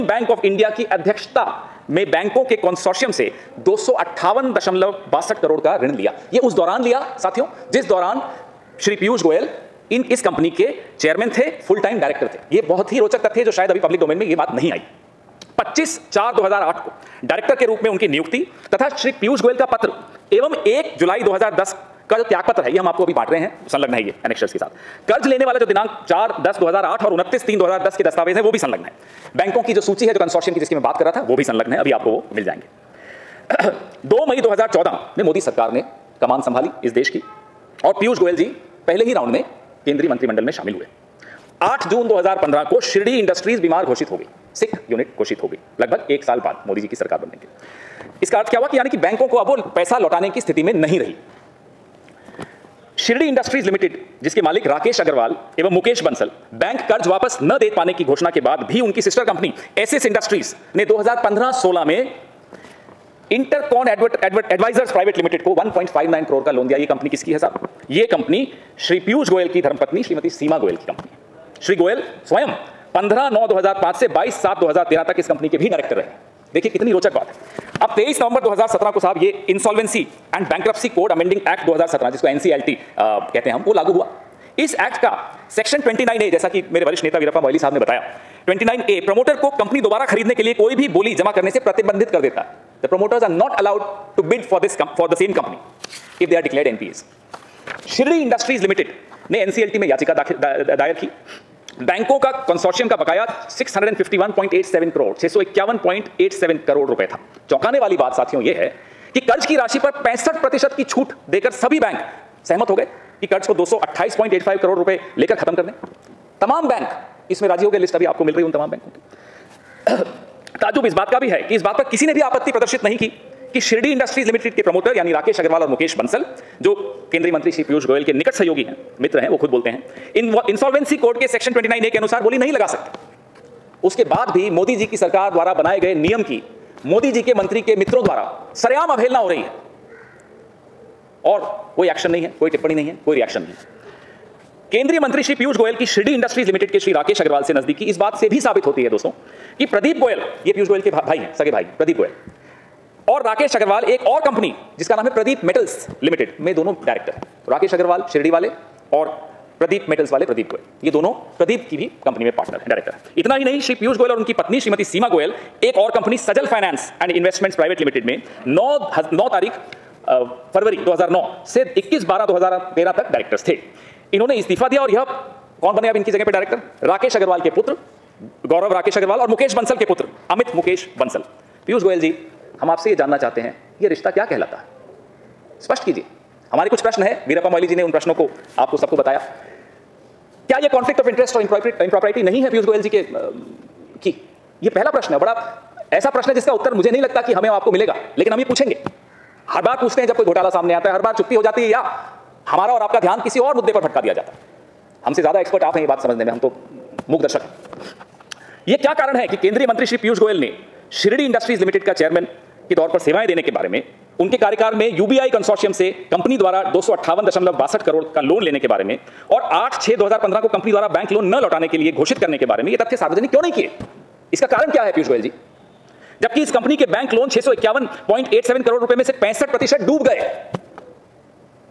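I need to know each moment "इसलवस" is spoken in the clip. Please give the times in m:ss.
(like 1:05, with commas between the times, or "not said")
1:19, 2:10.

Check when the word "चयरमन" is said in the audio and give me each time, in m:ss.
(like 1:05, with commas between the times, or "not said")
0:10, 3:31.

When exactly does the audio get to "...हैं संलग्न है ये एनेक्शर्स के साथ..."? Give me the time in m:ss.
0:23.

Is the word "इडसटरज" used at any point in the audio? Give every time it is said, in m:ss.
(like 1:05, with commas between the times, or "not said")
0:43, 0:53, 1:00, 1:38, 2:03, 2:26, 3:31.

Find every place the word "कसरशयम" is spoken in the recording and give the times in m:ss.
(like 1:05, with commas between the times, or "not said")
0:30, 1:42, 3:35.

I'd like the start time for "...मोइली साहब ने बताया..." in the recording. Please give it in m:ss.
1:27.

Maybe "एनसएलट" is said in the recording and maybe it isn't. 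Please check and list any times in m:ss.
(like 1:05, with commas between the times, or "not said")
1:22, 1:39.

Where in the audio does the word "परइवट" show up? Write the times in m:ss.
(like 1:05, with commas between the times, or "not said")
1:04, 2:47.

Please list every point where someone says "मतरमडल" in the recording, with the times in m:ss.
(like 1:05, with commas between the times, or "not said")
0:40.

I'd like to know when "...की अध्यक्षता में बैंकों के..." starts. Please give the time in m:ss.
0:00.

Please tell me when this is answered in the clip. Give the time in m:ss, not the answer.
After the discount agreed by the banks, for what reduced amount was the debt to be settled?
1:53.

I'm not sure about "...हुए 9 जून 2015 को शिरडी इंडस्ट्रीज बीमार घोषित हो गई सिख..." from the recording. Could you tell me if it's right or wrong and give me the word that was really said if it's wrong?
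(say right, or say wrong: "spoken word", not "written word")
wrong: "8", not "9".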